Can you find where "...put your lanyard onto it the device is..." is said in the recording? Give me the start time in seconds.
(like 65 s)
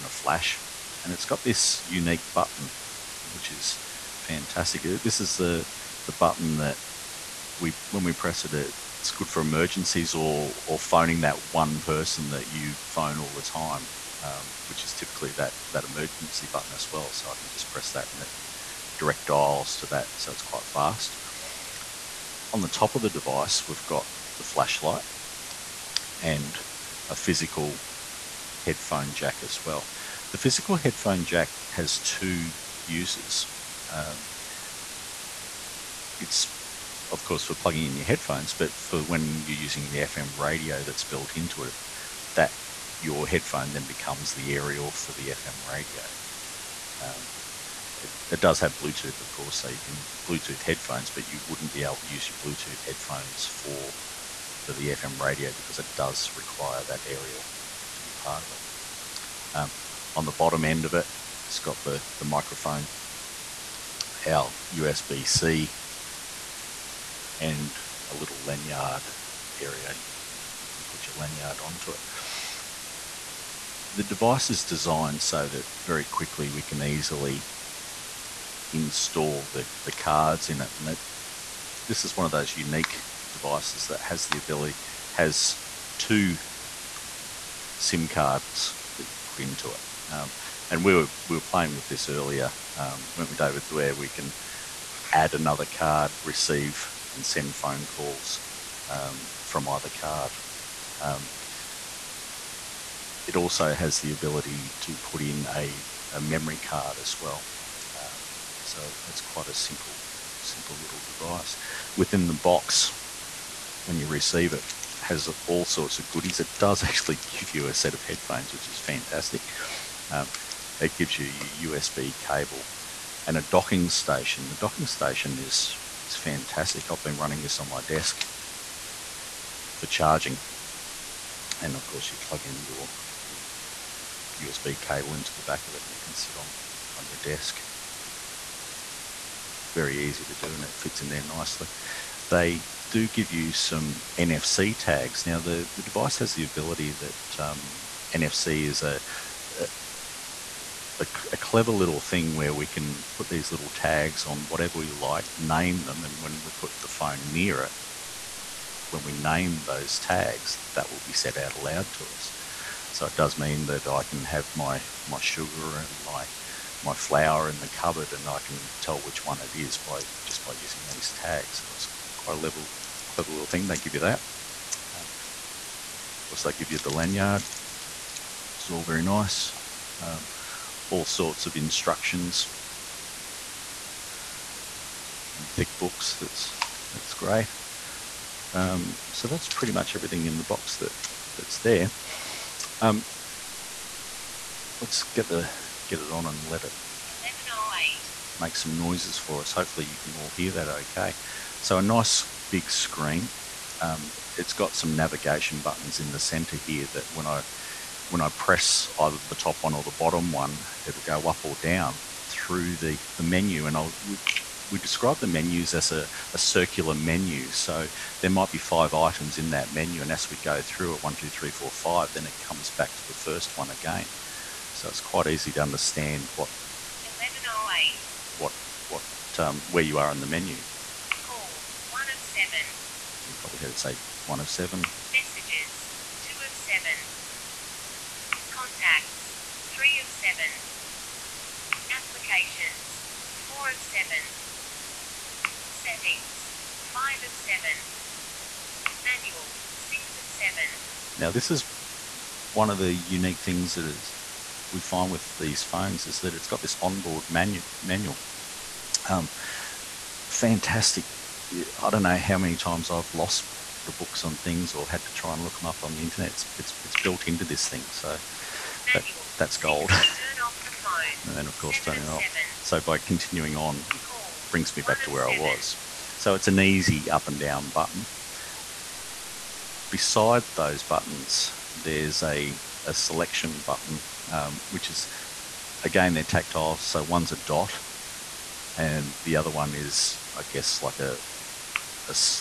70 s.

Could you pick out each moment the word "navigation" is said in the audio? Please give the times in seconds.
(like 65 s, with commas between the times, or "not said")
204 s.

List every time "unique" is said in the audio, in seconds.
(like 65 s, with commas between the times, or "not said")
1 s, 82 s, 252 s.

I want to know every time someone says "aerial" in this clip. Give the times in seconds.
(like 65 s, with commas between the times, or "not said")
44 s, 57 s.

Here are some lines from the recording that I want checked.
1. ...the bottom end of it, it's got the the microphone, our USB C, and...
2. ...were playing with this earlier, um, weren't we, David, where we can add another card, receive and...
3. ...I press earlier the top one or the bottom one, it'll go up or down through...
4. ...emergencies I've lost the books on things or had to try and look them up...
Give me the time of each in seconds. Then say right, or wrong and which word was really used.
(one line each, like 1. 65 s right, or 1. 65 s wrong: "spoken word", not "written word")
1. 60 s right
2. 91 s right
3. 208 s wrong: "either", not "earlier"
4. 262 s wrong: "times", not "emergencies".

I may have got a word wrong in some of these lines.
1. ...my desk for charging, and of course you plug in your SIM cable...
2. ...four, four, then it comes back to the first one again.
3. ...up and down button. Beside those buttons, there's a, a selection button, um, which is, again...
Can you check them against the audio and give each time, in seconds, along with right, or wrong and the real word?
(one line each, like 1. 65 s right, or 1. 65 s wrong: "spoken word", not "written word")
1. 127 s wrong: "USB", not "SIM"
2. 221 s wrong: "five", not "four"
3. 277 s right.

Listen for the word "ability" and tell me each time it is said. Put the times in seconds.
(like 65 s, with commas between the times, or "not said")
84 s, 104 s, 146 s.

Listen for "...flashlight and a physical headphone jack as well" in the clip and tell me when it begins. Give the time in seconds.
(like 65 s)
24 s.